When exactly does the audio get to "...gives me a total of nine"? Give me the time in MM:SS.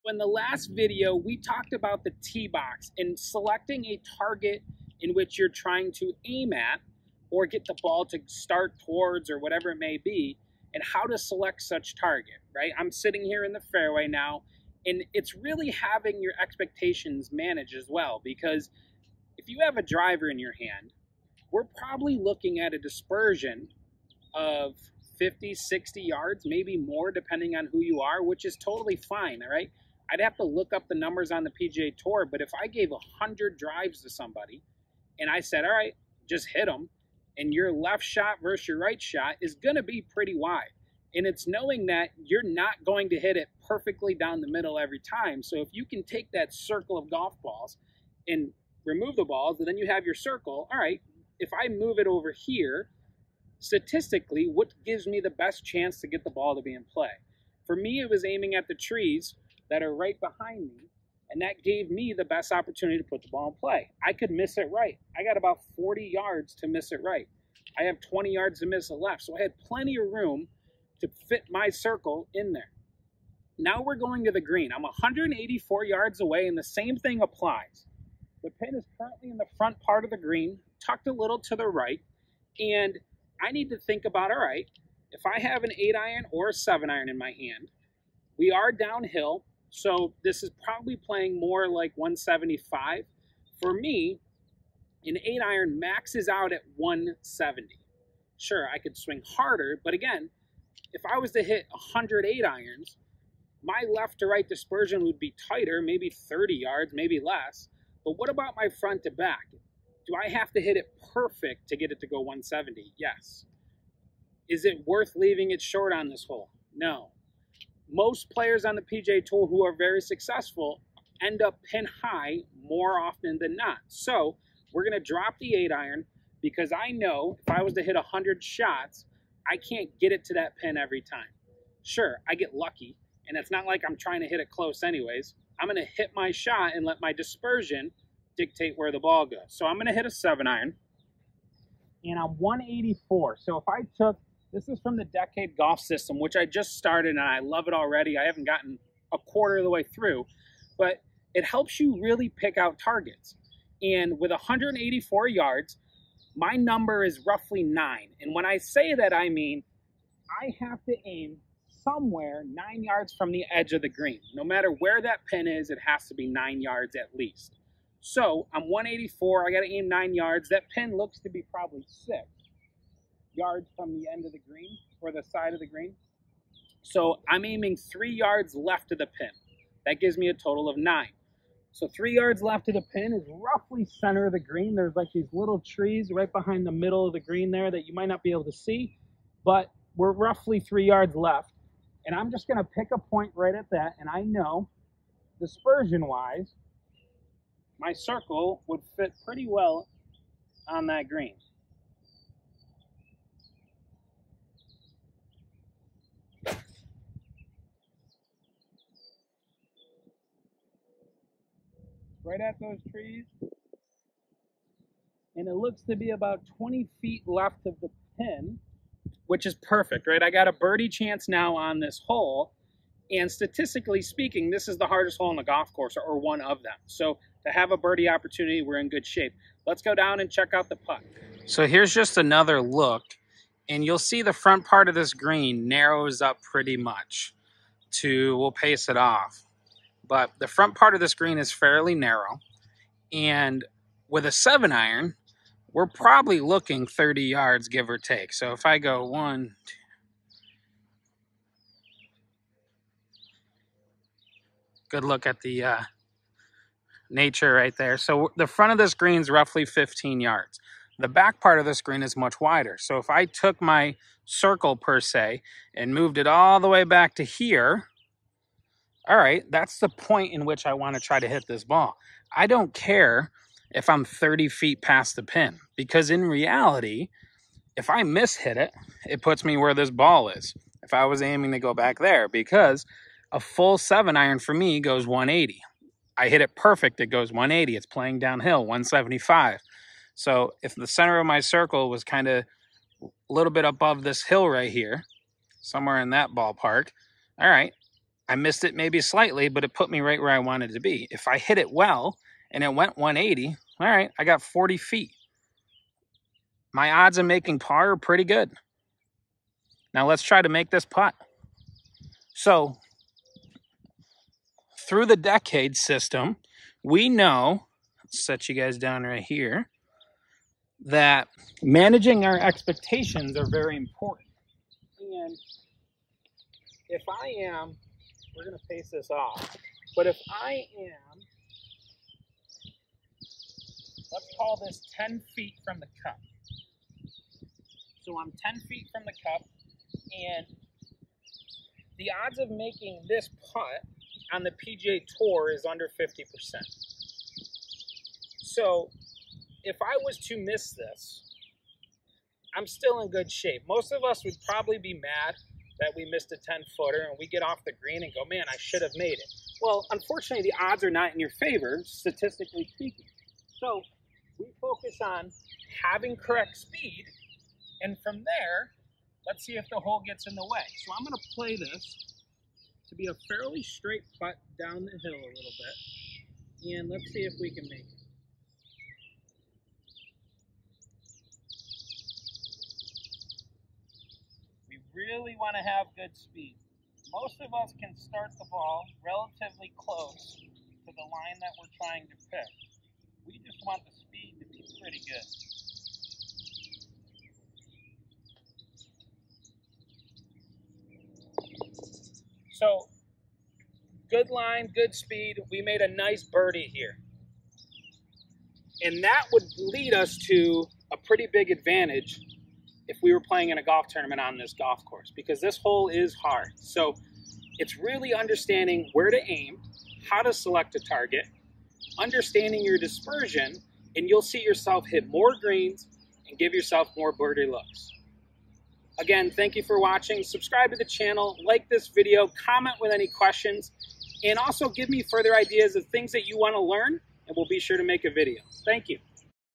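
02:59.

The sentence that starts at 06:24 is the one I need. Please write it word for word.
really want to have good speed.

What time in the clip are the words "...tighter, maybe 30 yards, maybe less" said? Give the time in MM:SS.
01:45.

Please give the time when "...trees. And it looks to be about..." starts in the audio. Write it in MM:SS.
03:32.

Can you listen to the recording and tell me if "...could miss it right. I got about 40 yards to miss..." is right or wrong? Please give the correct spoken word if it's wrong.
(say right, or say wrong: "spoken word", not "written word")
right.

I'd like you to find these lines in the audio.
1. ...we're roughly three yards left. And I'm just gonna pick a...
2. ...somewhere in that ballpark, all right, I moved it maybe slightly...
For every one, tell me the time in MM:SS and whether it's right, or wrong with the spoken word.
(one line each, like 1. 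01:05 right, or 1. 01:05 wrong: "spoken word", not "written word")
1. 03:09 right
2. 04:55 wrong: "missed", not "moved".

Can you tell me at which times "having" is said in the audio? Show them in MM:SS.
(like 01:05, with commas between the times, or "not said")
00:15, 06:05.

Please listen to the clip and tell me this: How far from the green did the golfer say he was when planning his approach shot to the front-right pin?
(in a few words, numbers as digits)
184 yards.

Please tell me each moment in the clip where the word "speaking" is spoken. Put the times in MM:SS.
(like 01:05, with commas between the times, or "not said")
03:44, 06:02.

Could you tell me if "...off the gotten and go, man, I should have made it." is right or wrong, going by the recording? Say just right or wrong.
wrong.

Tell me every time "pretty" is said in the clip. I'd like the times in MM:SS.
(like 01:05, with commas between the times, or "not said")
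00:40, 03:19, 03:56, 05:07, 06:34, 06:50.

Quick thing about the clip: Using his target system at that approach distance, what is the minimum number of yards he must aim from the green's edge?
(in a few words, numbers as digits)
9.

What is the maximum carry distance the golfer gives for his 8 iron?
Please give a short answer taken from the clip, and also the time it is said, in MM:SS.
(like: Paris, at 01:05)
170, at 01:35.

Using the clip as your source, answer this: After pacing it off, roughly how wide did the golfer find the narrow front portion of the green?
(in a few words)
15 yards.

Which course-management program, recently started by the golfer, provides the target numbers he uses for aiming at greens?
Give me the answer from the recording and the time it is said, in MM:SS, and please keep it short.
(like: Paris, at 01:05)
Decade Golf System, at 02:25.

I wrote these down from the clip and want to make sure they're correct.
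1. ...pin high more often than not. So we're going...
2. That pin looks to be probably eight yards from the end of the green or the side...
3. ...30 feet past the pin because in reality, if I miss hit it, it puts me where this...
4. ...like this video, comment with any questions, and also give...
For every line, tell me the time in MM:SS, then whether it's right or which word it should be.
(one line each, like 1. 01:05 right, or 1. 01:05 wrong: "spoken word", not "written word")
1. 02:01 right
2. 02:50 wrong: "six", not "eight"
3. 04:34 right
4. 07:11 right.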